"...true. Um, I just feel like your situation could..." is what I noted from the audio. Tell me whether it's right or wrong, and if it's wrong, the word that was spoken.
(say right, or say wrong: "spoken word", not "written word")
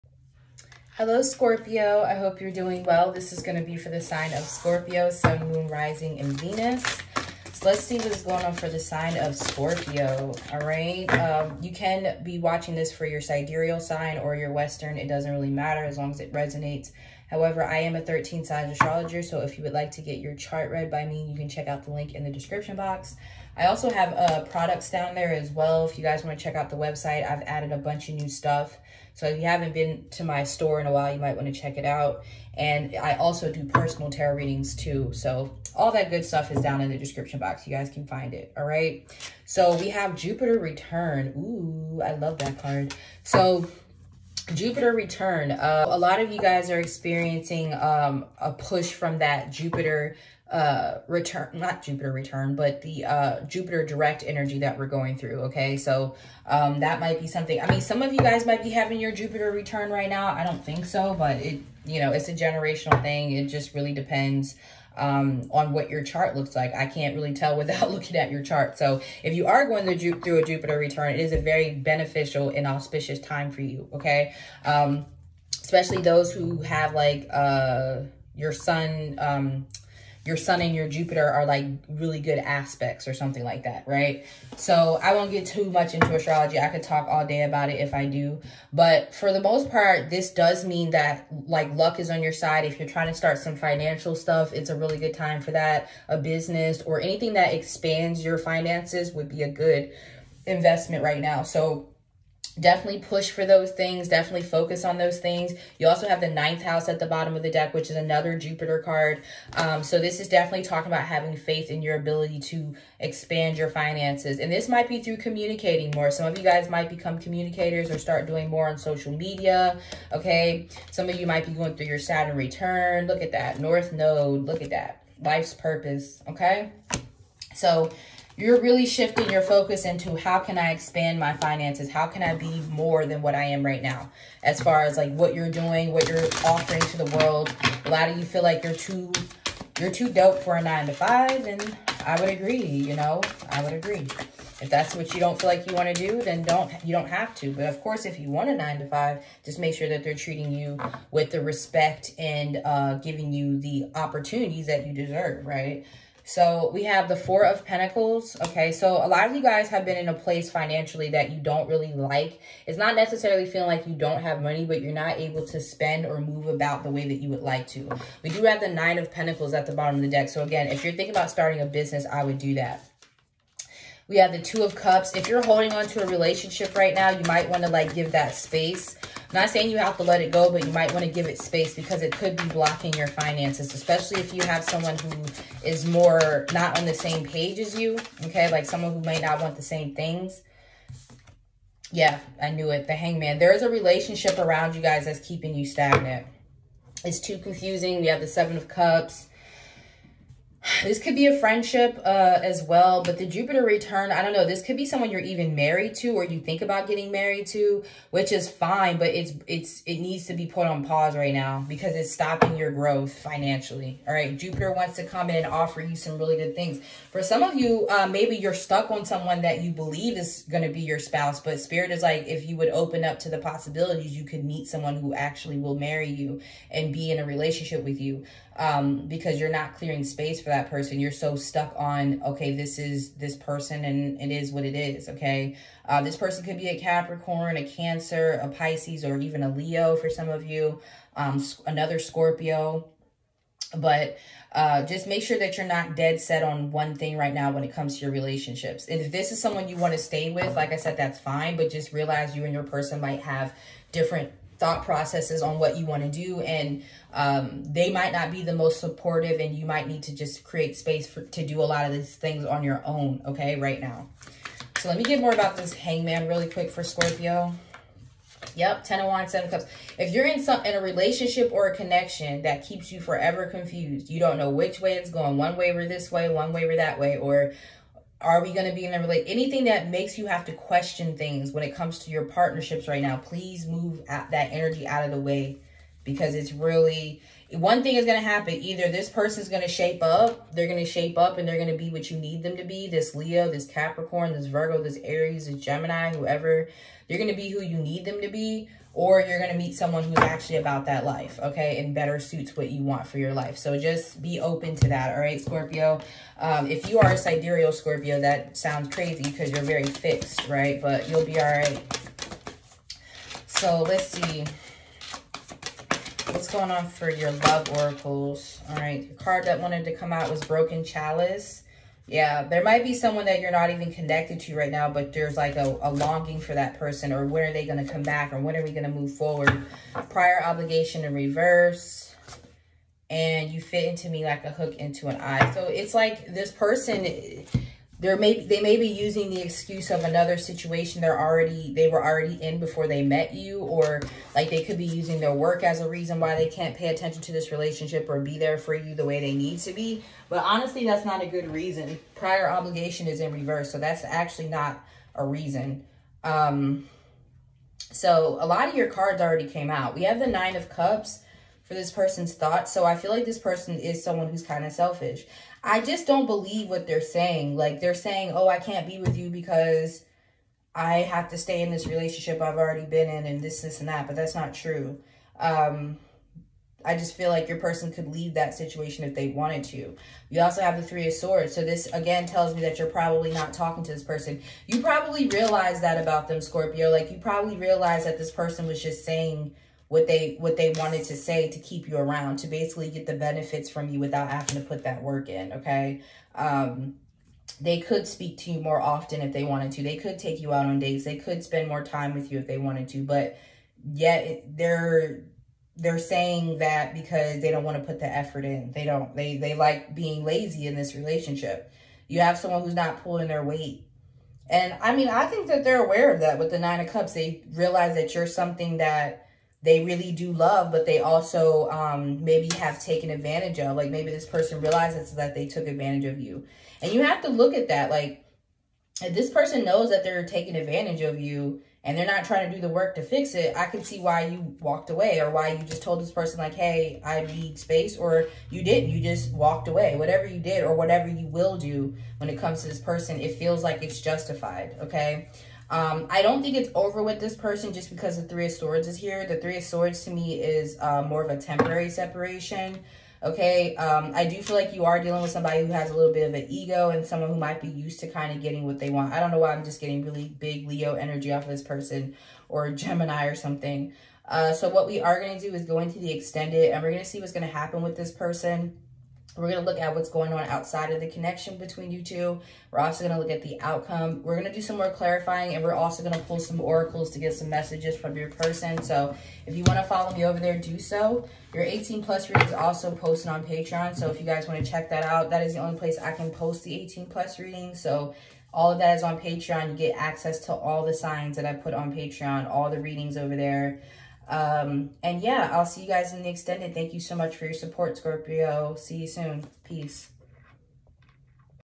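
wrong: "person", not "situation".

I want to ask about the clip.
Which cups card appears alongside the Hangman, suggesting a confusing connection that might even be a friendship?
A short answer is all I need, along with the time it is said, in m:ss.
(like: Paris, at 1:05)
seven of cups, at 3:18.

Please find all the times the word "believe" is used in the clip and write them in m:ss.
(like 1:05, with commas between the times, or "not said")
3:39, 6:06.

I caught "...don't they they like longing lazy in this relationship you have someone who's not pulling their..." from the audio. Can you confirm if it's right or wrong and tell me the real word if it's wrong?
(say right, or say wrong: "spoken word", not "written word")
wrong: "being", not "longing".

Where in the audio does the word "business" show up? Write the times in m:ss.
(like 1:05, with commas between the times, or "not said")
1:36, 2:51.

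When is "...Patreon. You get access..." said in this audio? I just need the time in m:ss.
8:09.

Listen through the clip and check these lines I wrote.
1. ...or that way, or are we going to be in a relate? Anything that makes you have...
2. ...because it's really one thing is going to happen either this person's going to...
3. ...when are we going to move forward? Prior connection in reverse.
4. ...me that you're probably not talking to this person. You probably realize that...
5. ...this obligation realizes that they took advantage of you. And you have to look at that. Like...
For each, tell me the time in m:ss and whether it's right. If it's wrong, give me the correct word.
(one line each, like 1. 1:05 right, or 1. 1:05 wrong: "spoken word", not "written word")
1. 4:36 right
2. 4:46 right
3. 5:28 wrong: "obligation", not "connection"
4. 6:22 right
5. 7:04 wrong: "person", not "obligation".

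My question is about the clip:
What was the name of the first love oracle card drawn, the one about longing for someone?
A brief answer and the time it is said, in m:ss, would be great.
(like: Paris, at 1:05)
Broken Chalice, at 5:20.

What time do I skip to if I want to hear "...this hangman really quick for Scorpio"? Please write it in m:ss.
4:25.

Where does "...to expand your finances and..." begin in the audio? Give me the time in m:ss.
1:52.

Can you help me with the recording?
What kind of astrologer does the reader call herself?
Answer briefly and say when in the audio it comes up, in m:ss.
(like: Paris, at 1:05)
13 signs astrologer, at 0:18.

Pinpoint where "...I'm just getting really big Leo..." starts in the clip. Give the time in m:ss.
7:39.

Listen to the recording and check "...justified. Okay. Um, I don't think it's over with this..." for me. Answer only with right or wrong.
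right.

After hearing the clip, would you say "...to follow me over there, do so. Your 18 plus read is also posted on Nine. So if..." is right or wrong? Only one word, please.
wrong.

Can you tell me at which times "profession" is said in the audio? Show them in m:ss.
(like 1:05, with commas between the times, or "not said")
not said.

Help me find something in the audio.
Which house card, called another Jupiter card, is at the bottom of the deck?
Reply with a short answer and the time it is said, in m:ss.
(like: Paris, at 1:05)
ninth house, at 1:46.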